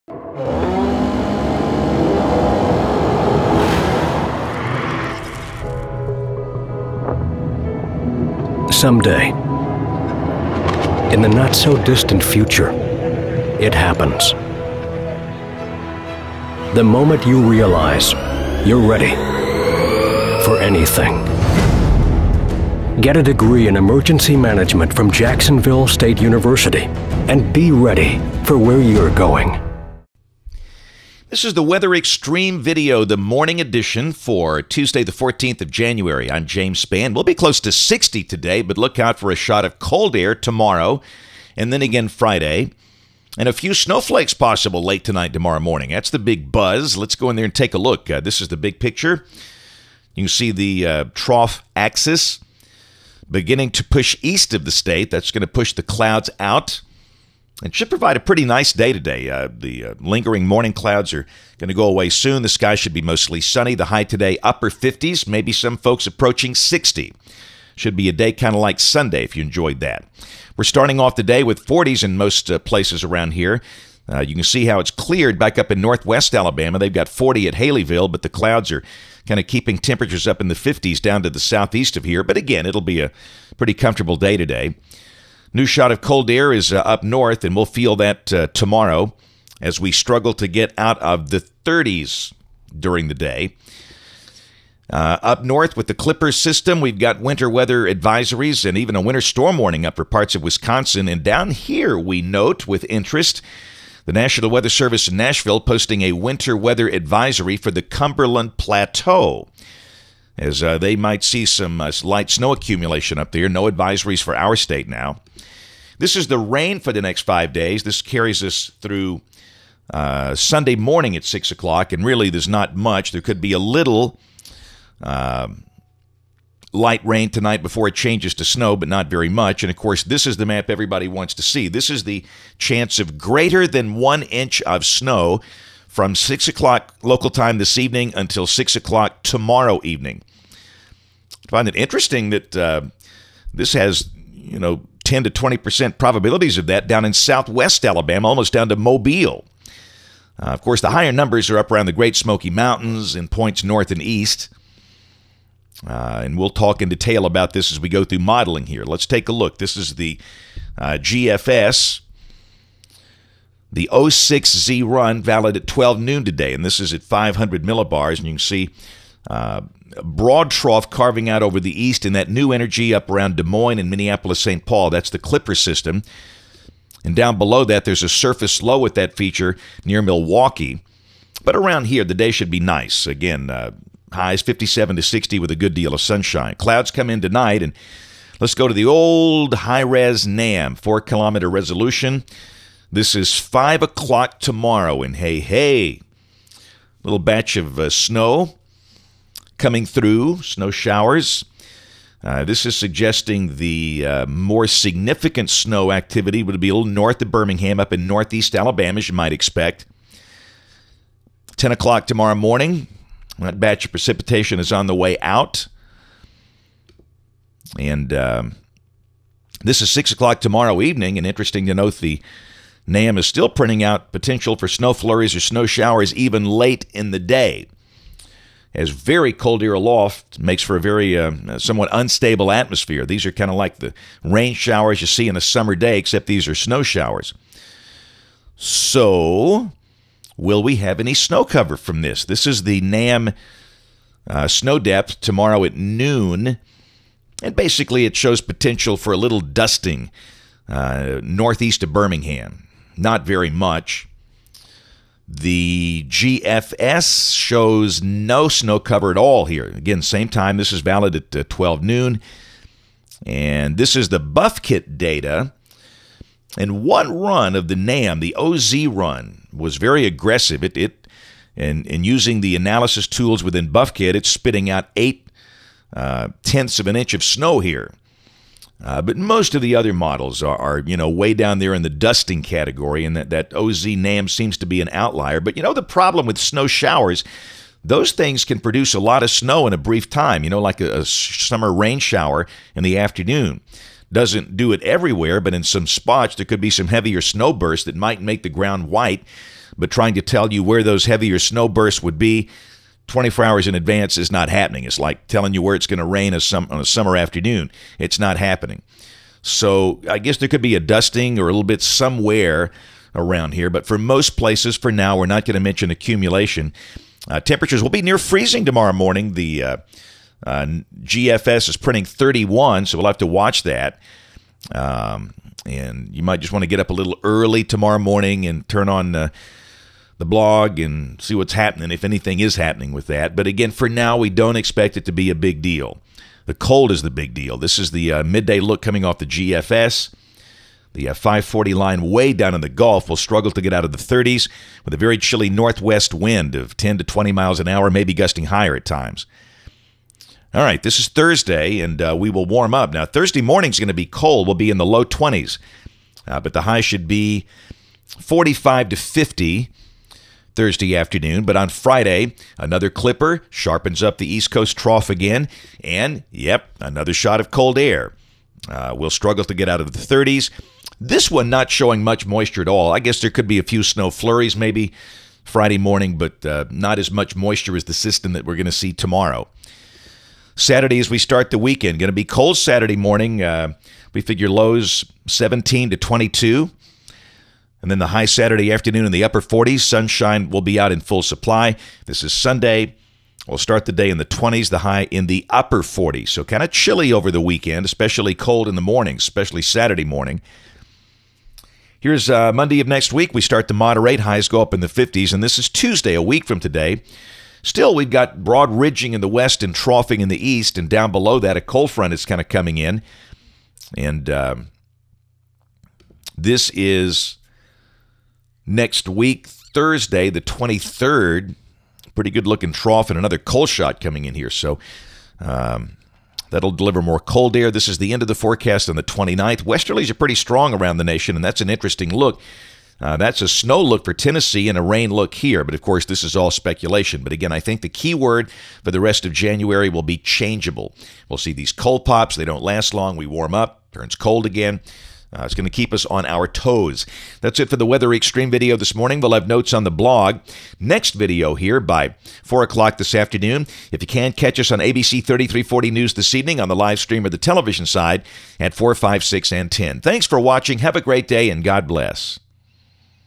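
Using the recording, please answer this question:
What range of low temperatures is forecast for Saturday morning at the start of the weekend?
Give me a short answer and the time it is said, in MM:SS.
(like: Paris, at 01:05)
17 to 22, at 06:25.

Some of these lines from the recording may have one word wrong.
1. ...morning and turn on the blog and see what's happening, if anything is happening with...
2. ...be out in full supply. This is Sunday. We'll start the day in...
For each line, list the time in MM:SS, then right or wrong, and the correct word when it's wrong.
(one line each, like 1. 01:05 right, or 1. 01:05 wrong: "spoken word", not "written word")
1. 05:27 right
2. 06:30 right.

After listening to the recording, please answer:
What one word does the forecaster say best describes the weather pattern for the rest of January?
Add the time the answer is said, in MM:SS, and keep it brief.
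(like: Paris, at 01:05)
Changeable, at 07:20.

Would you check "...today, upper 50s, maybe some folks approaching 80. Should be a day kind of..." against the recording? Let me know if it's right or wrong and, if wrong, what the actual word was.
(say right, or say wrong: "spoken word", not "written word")
wrong: "60", not "80".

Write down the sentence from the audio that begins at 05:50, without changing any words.
All right, this is Thursday, and uh, we will warm up.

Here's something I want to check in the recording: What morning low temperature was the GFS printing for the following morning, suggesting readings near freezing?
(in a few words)
31.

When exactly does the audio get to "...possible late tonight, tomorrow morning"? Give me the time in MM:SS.
00:44.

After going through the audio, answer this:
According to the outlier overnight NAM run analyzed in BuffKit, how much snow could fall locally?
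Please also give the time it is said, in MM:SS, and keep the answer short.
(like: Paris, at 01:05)
0.8 inch, at 04:34.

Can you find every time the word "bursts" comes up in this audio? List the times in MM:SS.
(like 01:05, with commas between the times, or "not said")
04:57, 05:01.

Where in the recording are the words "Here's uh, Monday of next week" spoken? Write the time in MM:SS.
06:41.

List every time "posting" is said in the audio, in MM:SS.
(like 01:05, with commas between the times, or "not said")
01:45.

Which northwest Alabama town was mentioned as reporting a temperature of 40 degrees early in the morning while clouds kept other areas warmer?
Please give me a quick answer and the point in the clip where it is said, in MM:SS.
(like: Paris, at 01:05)
Haleyville, at 01:17.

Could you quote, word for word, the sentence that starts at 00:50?
You see the uh, trough axis beginning to push east of the state.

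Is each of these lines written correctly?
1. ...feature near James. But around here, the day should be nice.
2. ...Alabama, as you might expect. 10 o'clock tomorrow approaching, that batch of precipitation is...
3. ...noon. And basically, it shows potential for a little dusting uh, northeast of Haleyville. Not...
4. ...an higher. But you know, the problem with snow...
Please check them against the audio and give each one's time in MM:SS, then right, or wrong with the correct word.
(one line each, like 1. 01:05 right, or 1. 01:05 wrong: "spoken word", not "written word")
1. 02:59 wrong: "Milwaukee", not "James"
2. 03:28 wrong: "morning", not "approaching"
3. 04:05 wrong: "Birmingham", not "Haleyville"
4. 04:44 wrong: "outlier", not "higher".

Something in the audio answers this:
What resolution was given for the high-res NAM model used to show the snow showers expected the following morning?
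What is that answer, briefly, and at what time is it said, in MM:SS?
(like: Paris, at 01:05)
4 kilometer, at 03:10.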